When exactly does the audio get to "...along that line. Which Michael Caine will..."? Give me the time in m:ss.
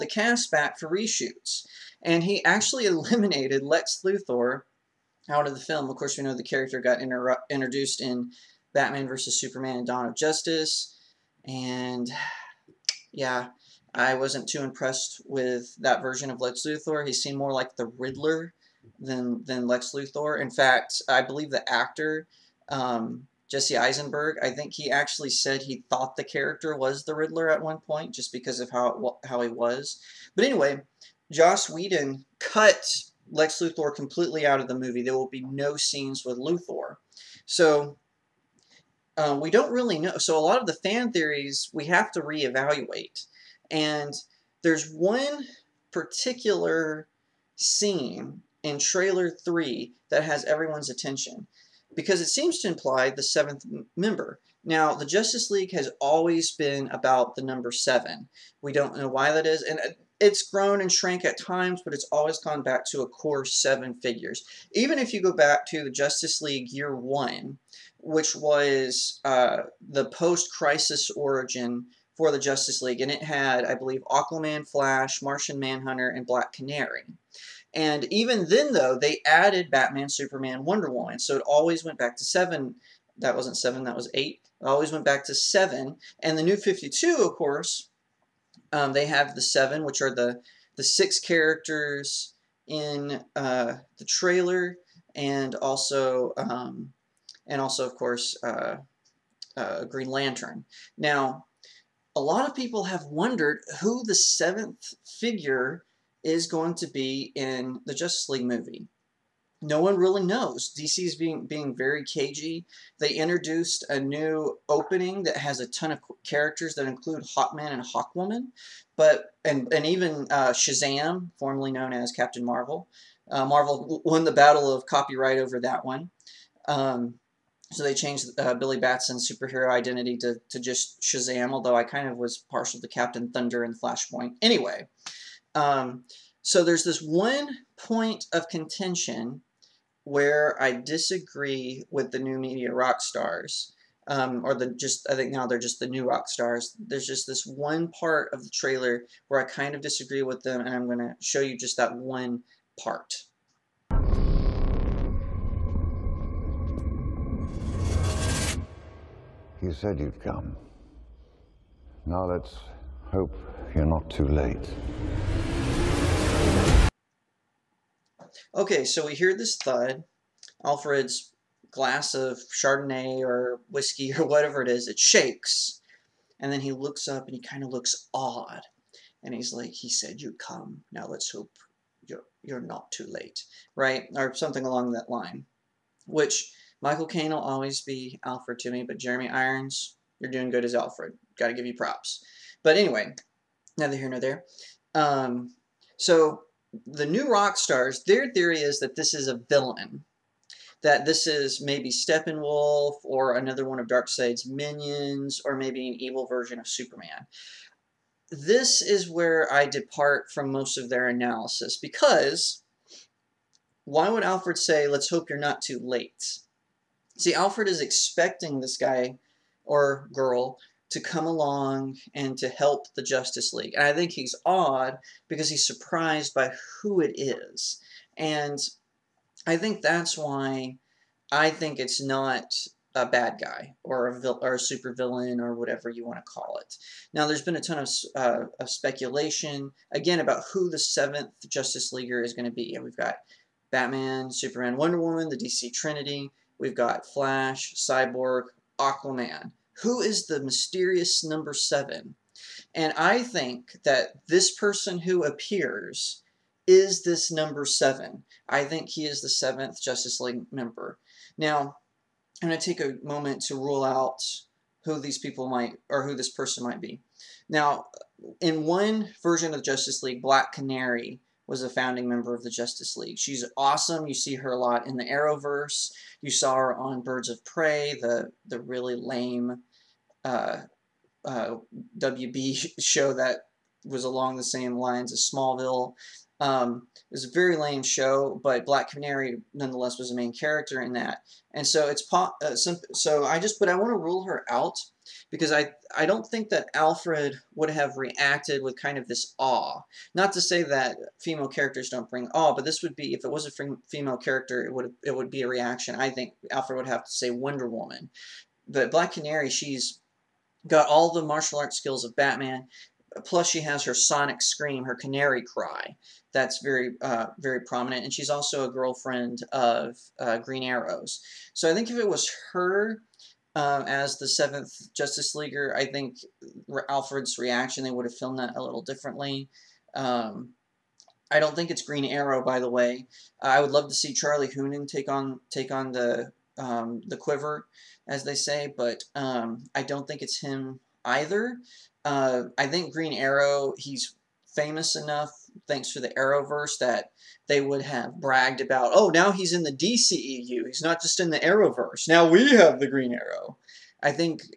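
3:04.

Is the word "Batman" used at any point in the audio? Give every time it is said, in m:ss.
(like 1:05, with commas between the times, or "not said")
0:08, 1:19, 4:03, 5:12.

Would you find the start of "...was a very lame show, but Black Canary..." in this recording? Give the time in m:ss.
4:47.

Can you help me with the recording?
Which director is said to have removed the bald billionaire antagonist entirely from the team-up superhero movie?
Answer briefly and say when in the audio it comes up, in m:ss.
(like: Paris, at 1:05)
Joss Whedon, at 0:31.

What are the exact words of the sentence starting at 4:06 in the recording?
We've got Flash, Cyborg, Aquaman who is the mysterious number seven?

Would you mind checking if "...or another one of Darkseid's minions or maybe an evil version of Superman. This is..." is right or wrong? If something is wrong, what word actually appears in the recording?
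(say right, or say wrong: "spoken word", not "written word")
right.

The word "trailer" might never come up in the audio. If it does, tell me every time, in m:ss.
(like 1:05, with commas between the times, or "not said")
0:48, 1:34, 2:28.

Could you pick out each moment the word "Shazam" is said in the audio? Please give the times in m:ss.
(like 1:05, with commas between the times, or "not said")
2:00, 2:11.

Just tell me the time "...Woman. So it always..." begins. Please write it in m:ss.
1:20.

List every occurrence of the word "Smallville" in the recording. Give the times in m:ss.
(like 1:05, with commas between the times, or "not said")
4:45.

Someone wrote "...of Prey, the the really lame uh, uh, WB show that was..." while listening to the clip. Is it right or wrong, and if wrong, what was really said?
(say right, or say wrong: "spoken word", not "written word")
right.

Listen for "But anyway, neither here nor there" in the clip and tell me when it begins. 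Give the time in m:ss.
3:12.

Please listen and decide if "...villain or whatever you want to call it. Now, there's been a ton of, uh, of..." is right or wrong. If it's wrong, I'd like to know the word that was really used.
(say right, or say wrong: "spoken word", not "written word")
right.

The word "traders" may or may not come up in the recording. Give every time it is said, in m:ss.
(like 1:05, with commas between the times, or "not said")
not said.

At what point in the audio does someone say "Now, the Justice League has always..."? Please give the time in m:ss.
0:54.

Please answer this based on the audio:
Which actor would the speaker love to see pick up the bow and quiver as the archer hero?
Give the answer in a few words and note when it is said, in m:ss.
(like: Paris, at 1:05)
Charlie Hunnam, at 5:34.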